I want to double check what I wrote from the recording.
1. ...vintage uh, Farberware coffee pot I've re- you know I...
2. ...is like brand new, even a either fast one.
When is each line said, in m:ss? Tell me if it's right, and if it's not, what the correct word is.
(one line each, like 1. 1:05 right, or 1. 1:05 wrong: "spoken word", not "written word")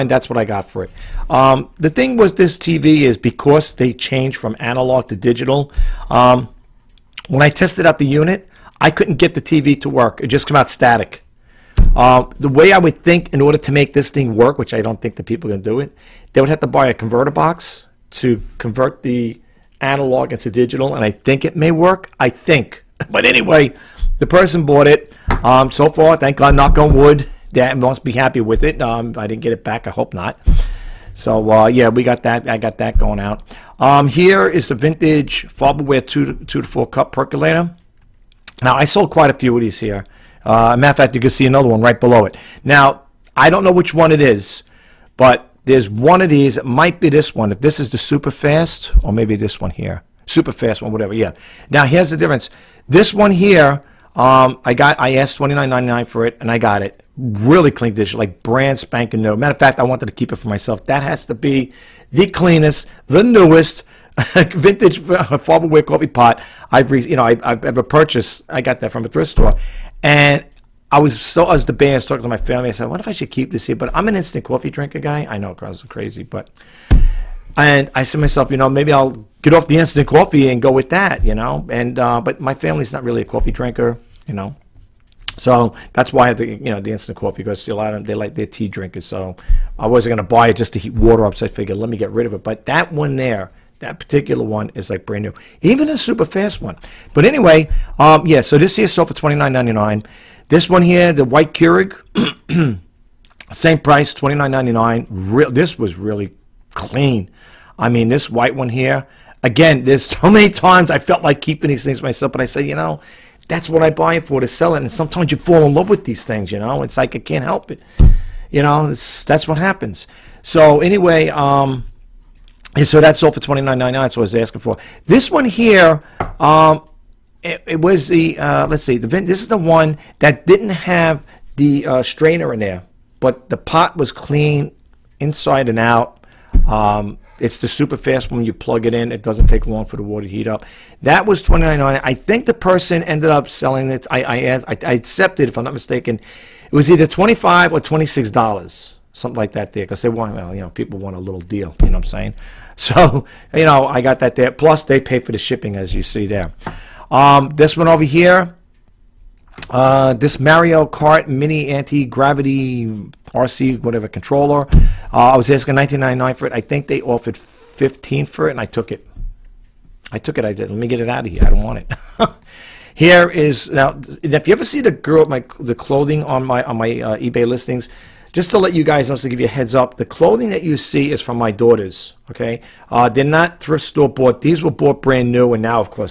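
1. 1:04 right
2. 1:34 wrong: "super", not "either".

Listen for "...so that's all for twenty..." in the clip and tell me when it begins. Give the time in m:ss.
2:02.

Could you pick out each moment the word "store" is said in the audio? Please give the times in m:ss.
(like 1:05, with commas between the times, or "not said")
1:09, 3:03.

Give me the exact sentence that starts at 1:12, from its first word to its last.
I said, "What if I should keep this here?" But I'm an instant coffee drinker guy.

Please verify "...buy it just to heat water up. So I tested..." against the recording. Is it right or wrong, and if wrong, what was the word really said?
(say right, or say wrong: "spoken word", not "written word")
wrong: "figured", not "tested".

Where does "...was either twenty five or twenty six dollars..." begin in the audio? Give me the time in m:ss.
2:26.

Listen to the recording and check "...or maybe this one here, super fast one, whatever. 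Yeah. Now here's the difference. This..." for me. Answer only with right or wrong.
right.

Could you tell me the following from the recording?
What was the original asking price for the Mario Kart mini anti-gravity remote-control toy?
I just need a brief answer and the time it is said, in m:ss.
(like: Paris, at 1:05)
$19.99, at 2:45.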